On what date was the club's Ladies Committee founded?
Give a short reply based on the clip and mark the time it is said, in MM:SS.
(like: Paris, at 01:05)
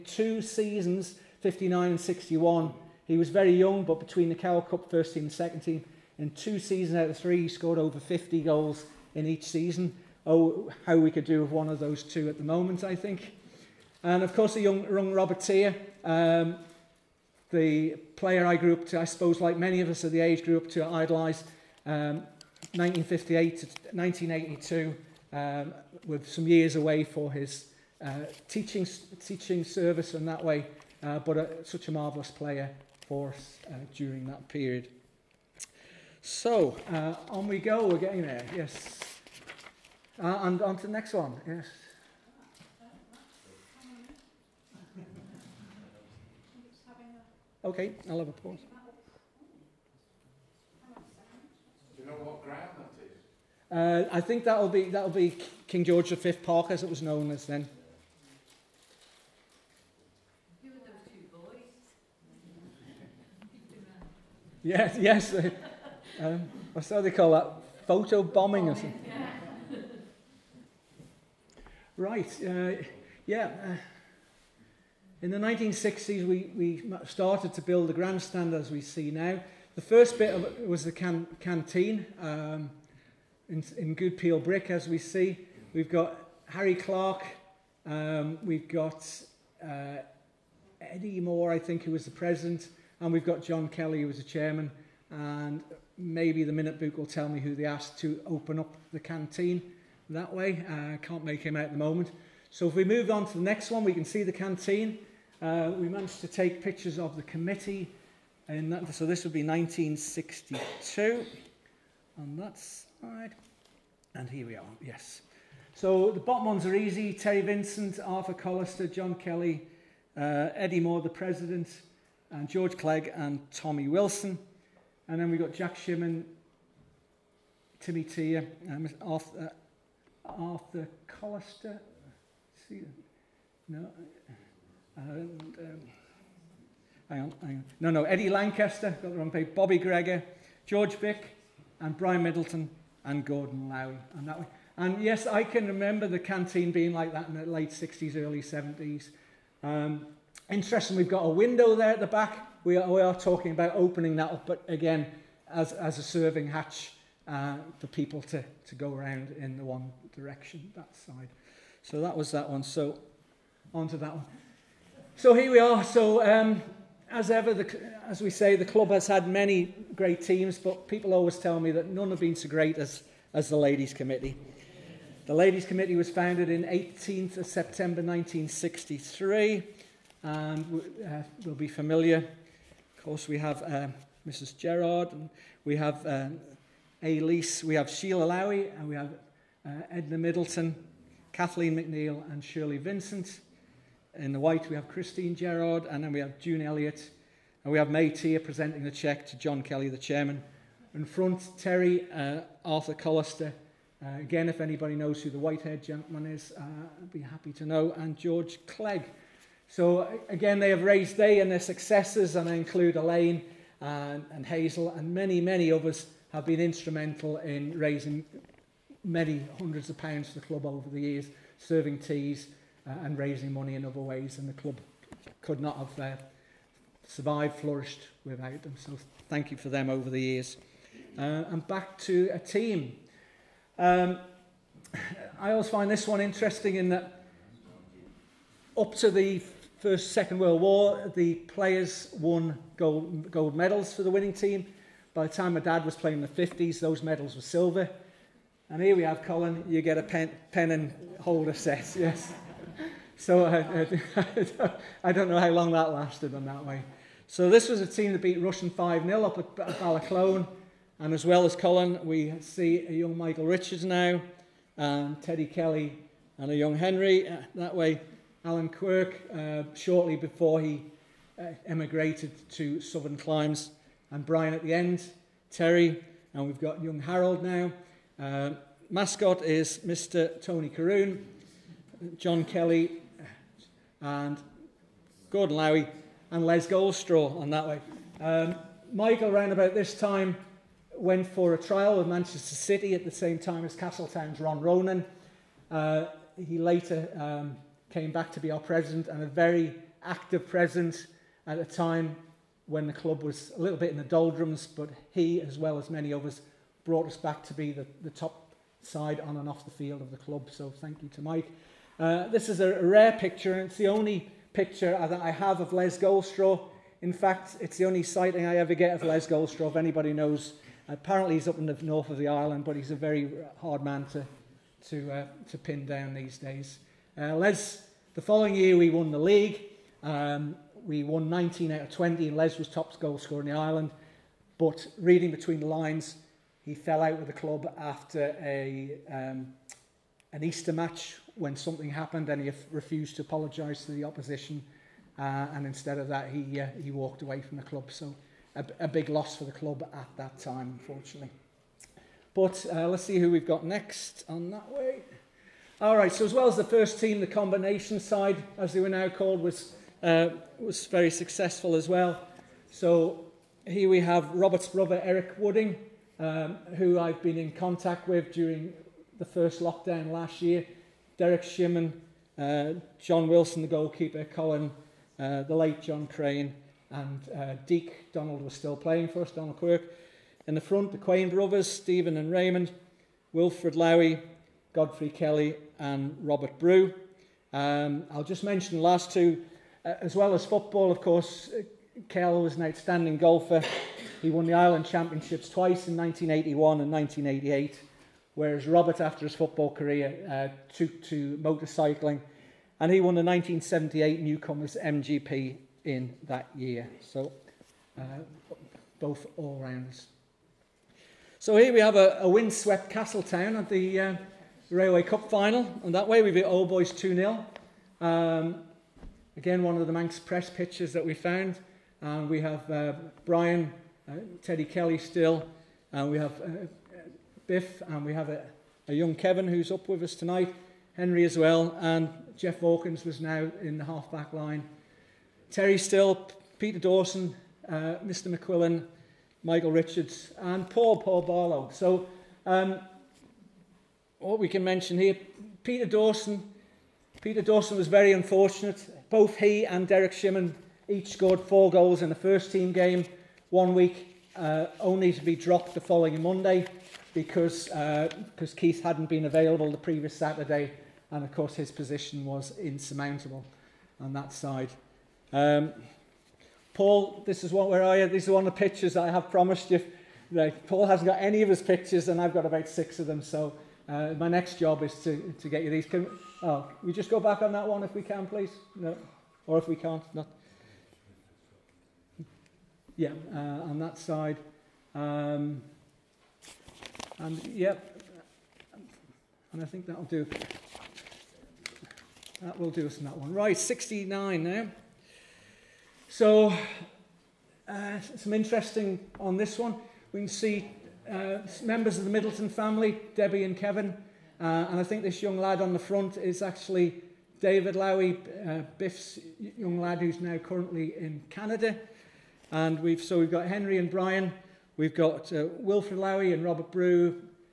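18 September 1963, at 02:56.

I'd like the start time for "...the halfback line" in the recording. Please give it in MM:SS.
07:13.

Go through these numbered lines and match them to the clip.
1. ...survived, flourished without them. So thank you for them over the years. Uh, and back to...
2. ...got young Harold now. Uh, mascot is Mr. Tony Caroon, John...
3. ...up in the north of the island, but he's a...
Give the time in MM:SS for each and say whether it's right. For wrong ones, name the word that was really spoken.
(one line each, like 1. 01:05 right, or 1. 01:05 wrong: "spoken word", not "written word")
1. 03:47 right
2. 04:36 right
3. 05:21 right.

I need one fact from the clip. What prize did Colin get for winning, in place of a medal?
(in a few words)
Pen and holder set.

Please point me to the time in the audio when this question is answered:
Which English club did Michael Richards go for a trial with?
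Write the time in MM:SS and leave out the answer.
04:52.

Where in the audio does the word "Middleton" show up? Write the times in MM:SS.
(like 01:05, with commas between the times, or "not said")
02:22, 03:10, 08:22.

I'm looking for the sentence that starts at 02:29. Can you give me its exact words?
Um, interesting, we've got a window there at the back.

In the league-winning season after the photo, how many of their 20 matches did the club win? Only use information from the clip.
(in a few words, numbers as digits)
19.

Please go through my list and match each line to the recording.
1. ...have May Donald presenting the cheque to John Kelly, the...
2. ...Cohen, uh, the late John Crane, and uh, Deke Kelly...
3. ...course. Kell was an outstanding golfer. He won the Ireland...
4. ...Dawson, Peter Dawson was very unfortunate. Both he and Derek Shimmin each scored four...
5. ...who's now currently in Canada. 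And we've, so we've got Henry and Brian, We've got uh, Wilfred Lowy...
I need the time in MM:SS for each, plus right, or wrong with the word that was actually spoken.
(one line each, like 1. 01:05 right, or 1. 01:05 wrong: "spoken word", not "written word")
1. 03:17 wrong: "Tier", not "Donald"
2. 06:14 wrong: "Donald", not "Kelly"
3. 06:30 right
4. 07:25 right
5. 08:29 right.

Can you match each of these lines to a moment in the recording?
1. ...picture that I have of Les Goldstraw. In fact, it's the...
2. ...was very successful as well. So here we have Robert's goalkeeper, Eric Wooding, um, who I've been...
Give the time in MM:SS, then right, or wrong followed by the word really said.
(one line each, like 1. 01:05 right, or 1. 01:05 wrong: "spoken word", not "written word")
1. 05:14 right
2. 06:00 wrong: "brother", not "goalkeeper".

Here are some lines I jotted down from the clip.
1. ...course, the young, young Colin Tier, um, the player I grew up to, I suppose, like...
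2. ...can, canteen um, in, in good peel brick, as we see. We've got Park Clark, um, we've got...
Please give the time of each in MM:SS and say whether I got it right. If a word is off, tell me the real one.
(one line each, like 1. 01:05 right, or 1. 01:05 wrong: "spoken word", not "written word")
1. 00:14 wrong: "Robert", not "Colin"
2. 01:20 wrong: "Harry", not "Park".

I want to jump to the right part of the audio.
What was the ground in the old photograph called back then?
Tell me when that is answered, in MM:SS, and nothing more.
00:55.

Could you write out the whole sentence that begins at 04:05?
By the time my dad was playing in the 50s, those medals were silver.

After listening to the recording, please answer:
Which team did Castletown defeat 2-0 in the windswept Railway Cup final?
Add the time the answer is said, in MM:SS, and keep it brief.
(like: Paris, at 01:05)
Old Boys, at 06:56.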